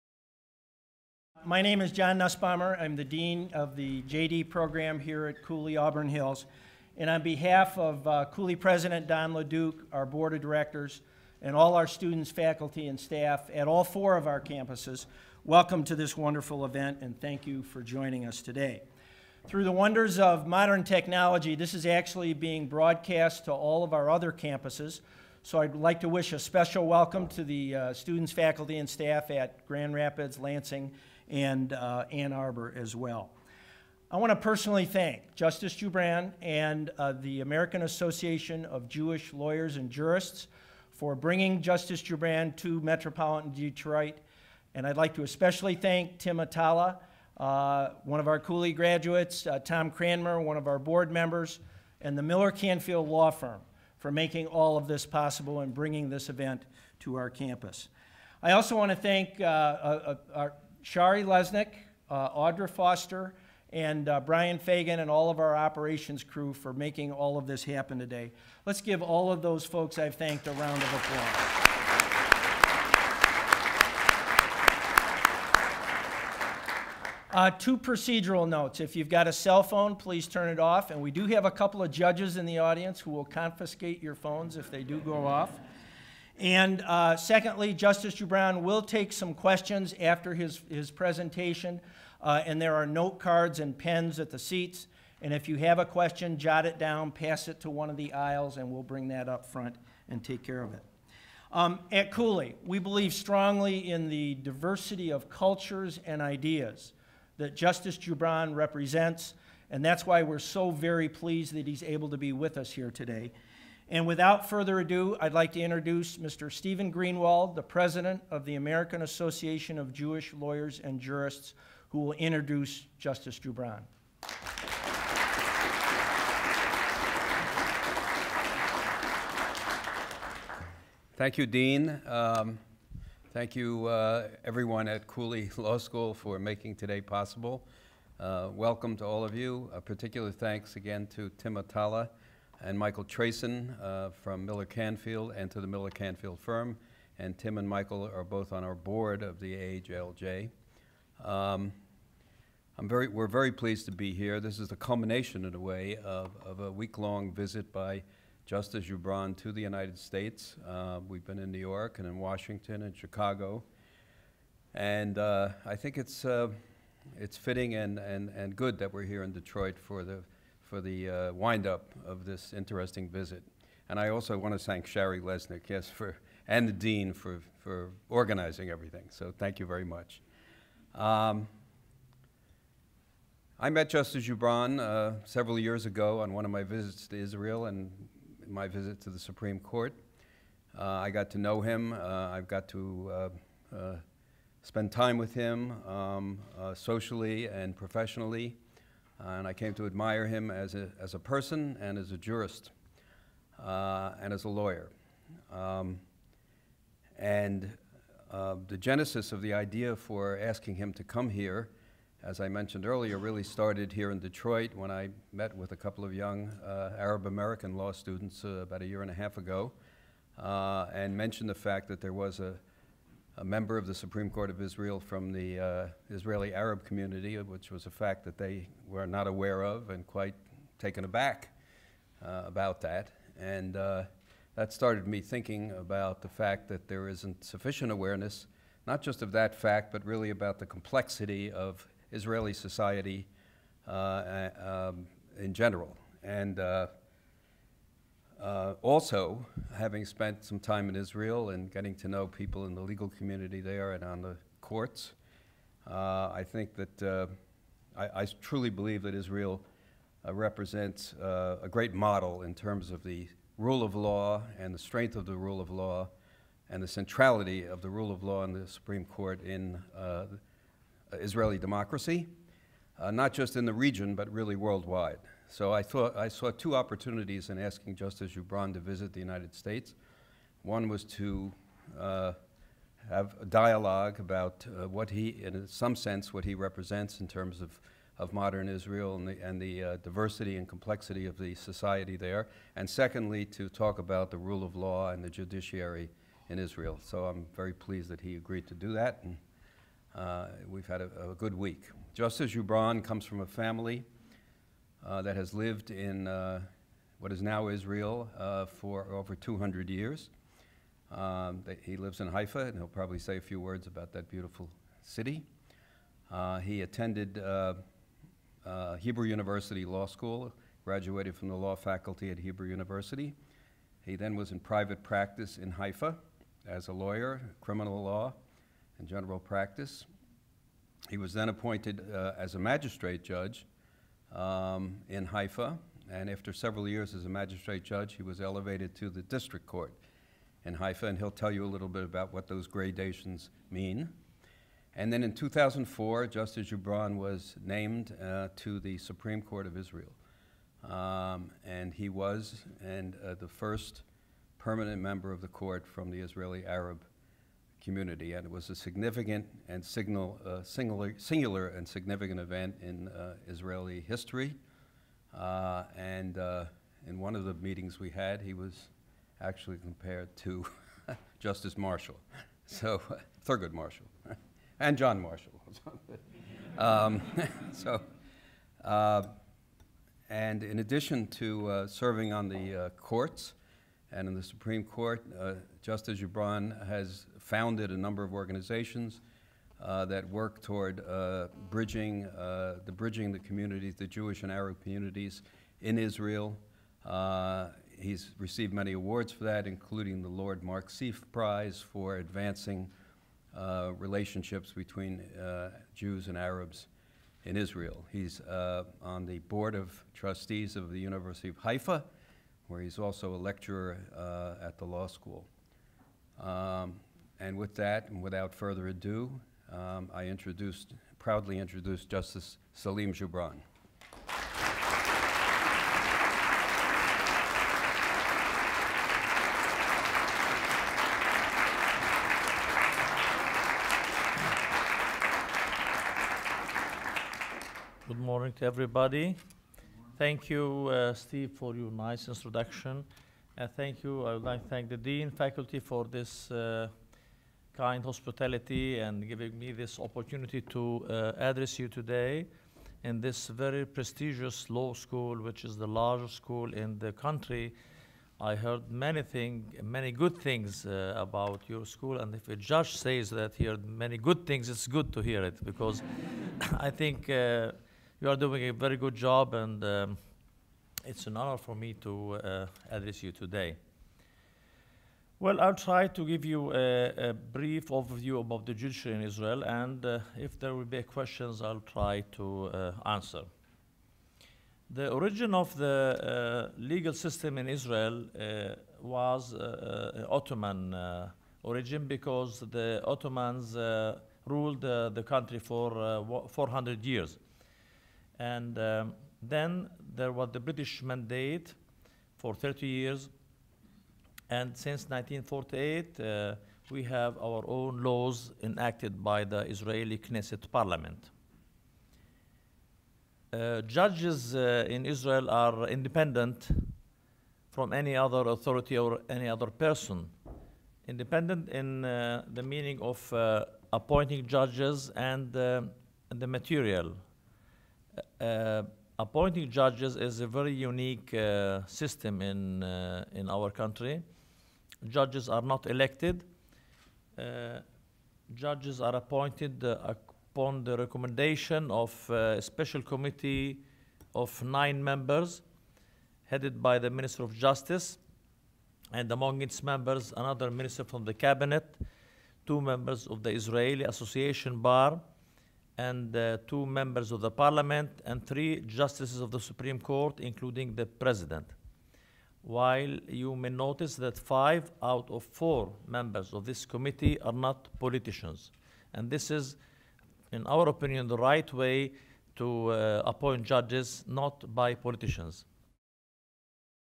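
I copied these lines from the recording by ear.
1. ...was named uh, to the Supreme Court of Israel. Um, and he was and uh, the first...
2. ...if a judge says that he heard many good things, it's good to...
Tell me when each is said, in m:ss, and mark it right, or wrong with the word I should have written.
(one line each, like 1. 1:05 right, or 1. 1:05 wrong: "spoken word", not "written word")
1. 5:47 right
2. 7:42 right.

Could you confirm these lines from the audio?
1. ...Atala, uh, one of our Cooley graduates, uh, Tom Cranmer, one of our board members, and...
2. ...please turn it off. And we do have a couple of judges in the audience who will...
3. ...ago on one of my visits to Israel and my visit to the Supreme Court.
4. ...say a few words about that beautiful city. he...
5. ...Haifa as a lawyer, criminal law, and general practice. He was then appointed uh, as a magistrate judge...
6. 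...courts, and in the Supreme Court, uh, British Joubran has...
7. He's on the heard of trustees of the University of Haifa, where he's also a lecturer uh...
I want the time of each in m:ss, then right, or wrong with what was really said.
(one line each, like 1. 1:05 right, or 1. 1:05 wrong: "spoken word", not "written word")
1. 0:46 right
2. 1:19 right
3. 3:05 right
4. 5:13 right
5. 5:25 right
6. 6:22 wrong: "Justice", not "British"
7. 6:48 wrong: "board", not "heard".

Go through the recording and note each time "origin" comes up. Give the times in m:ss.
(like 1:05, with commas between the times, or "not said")
8:05, 8:11.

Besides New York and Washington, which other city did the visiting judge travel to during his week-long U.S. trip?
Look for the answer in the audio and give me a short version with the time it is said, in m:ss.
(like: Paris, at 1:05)
Chicago, at 2:42.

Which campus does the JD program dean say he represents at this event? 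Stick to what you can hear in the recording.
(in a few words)
Auburn Hills.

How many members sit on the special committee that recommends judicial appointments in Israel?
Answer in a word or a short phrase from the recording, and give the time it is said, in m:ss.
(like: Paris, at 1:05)
9, at 9:04.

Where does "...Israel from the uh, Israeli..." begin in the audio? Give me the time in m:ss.
3:44.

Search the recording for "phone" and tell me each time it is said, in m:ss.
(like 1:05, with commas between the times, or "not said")
1:19, 1:24.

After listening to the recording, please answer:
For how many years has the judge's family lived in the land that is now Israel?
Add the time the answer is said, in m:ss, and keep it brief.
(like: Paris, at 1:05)
over 200, at 5:09.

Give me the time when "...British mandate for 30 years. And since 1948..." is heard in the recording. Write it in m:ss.
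8:20.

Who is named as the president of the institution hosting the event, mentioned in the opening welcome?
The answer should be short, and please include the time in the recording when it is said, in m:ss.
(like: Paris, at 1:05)
Don LeDuc, at 0:09.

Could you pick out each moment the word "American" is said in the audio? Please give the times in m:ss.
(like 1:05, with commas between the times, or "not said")
0:37, 1:58, 3:37.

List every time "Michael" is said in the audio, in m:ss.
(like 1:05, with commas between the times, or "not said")
2:22, 2:27.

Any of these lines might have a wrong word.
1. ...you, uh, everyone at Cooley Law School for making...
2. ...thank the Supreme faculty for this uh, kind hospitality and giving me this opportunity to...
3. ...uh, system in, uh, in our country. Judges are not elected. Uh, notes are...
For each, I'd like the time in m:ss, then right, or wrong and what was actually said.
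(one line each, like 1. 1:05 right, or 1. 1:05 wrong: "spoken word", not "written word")
1. 2:13 right
2. 7:24 wrong: "Dean", not "Supreme"
3. 8:51 wrong: "judges", not "notes".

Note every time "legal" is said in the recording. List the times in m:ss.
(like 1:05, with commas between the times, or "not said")
4:12, 8:06.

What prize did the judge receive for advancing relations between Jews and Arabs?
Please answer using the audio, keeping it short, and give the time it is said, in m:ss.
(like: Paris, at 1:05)
Lord Mark Seif Prize, at 6:40.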